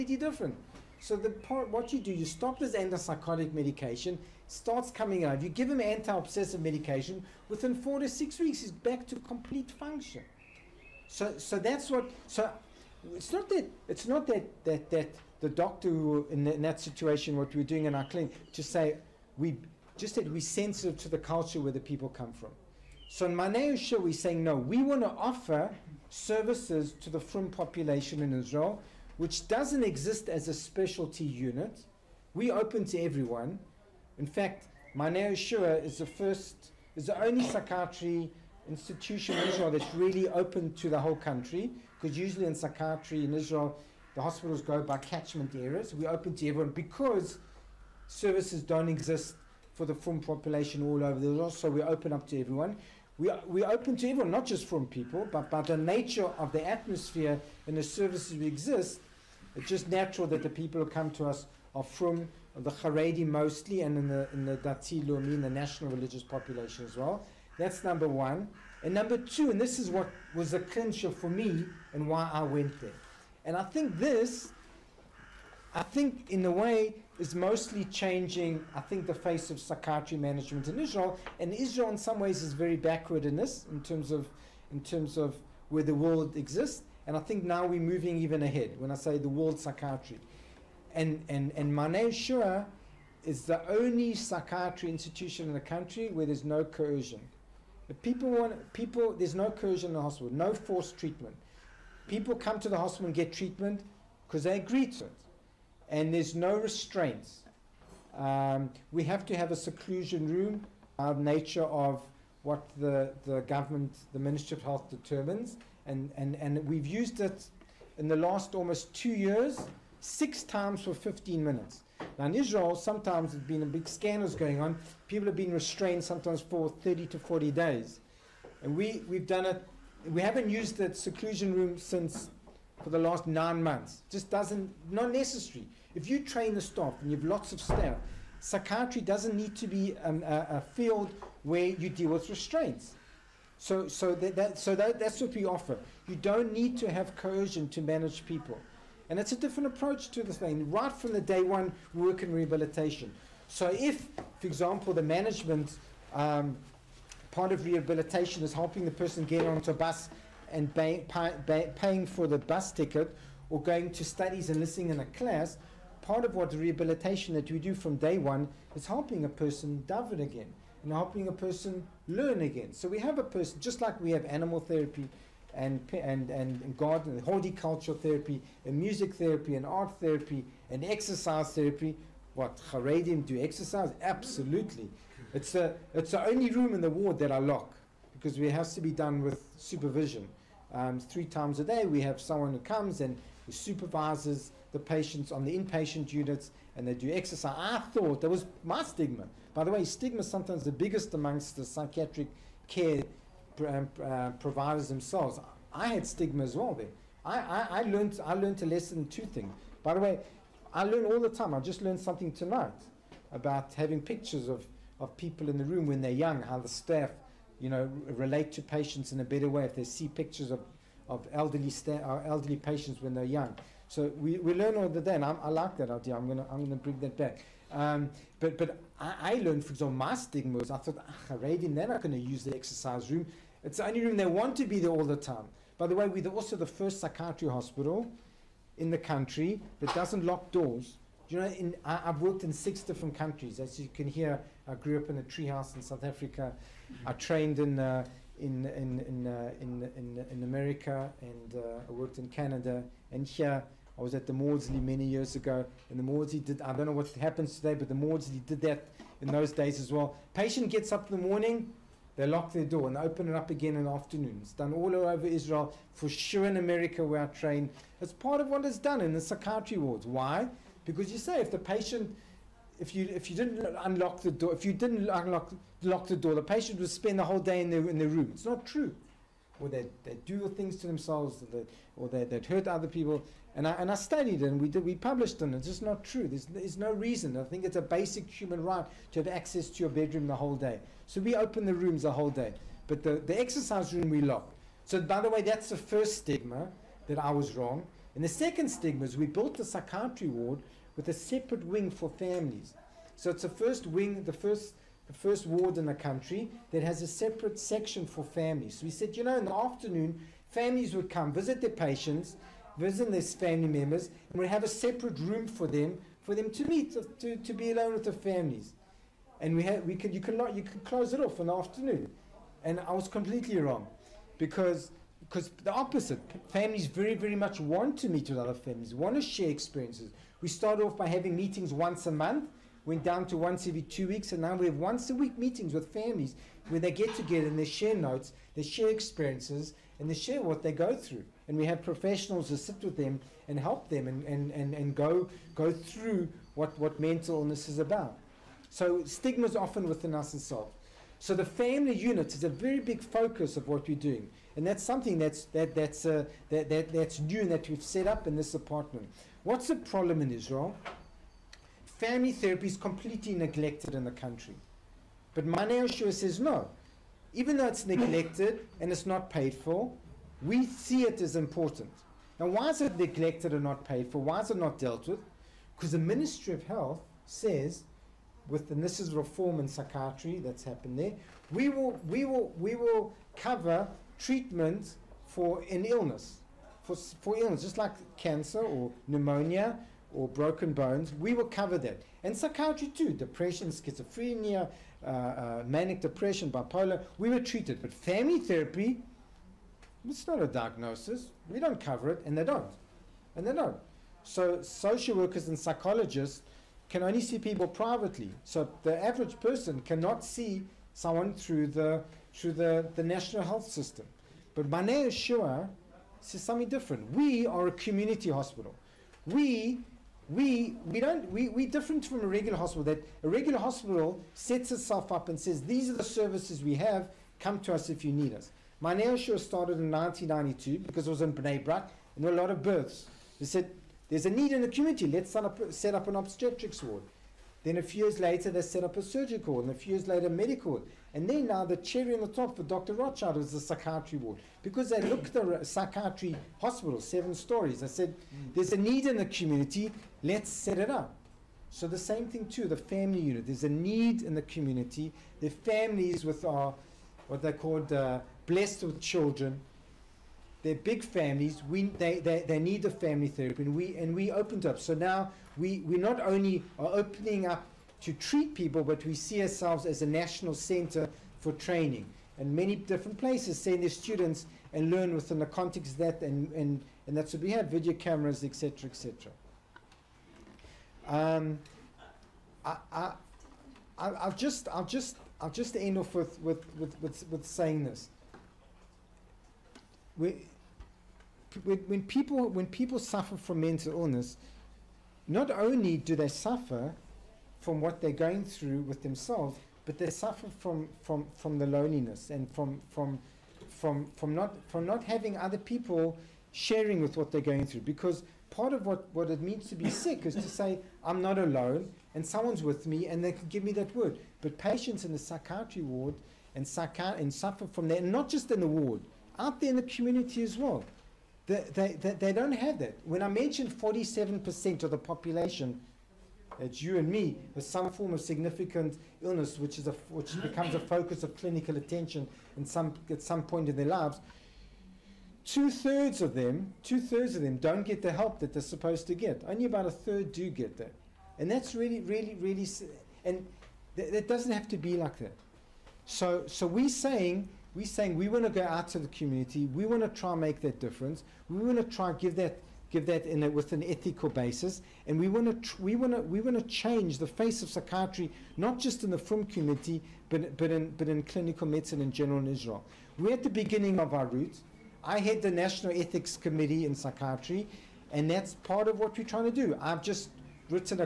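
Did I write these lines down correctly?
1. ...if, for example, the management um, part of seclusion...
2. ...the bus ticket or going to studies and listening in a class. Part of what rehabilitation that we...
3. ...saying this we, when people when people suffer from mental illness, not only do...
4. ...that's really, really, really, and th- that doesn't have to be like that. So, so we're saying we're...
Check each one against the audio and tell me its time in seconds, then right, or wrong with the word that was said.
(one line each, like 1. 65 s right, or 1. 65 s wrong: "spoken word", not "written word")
1. 153 s wrong: "rehabilitation", not "seclusion"
2. 162 s right
3. 487 s right
4. 541 s right.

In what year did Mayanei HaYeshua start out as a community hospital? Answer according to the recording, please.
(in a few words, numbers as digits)
1992.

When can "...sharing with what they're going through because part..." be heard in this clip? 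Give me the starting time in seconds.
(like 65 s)
506 s.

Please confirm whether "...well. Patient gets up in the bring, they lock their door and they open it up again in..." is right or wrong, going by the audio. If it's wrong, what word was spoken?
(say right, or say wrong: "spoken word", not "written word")
wrong: "morning", not "bring".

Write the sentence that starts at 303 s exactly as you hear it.
So it's the first wing, the first the first ward in the country that has a separate section for families.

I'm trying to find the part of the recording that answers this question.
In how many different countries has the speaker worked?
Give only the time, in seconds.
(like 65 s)
242 s.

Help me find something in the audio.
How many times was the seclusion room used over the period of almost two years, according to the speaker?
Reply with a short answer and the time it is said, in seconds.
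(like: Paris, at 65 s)
6, at 120 s.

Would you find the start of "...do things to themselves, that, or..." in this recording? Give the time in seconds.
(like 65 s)
280 s.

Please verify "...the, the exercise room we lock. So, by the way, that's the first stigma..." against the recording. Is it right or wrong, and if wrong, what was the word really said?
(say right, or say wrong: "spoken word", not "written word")
right.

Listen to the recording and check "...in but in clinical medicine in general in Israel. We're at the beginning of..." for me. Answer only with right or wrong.
right.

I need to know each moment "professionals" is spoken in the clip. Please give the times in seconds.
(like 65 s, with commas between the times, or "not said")
341 s.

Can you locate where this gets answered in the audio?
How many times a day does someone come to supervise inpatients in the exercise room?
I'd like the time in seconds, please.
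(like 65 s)
191 s.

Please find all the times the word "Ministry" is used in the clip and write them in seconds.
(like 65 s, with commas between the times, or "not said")
114 s, 375 s.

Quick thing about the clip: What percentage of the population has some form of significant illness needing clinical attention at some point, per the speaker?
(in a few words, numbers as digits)
47%.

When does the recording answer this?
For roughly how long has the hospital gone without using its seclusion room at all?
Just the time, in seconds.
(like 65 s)
133 s.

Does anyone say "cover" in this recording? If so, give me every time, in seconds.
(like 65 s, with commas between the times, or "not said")
383 s, 391 s, 401 s.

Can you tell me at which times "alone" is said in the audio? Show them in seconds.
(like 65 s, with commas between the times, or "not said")
317 s, 511 s.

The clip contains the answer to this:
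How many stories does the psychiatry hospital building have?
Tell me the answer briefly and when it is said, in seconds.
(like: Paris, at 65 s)
7, at 447 s.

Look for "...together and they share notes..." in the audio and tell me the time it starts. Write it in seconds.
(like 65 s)
337 s.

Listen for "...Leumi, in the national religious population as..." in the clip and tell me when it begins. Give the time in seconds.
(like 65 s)
65 s.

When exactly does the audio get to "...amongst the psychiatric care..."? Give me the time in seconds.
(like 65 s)
201 s.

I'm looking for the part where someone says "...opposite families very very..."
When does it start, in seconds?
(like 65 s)
325 s.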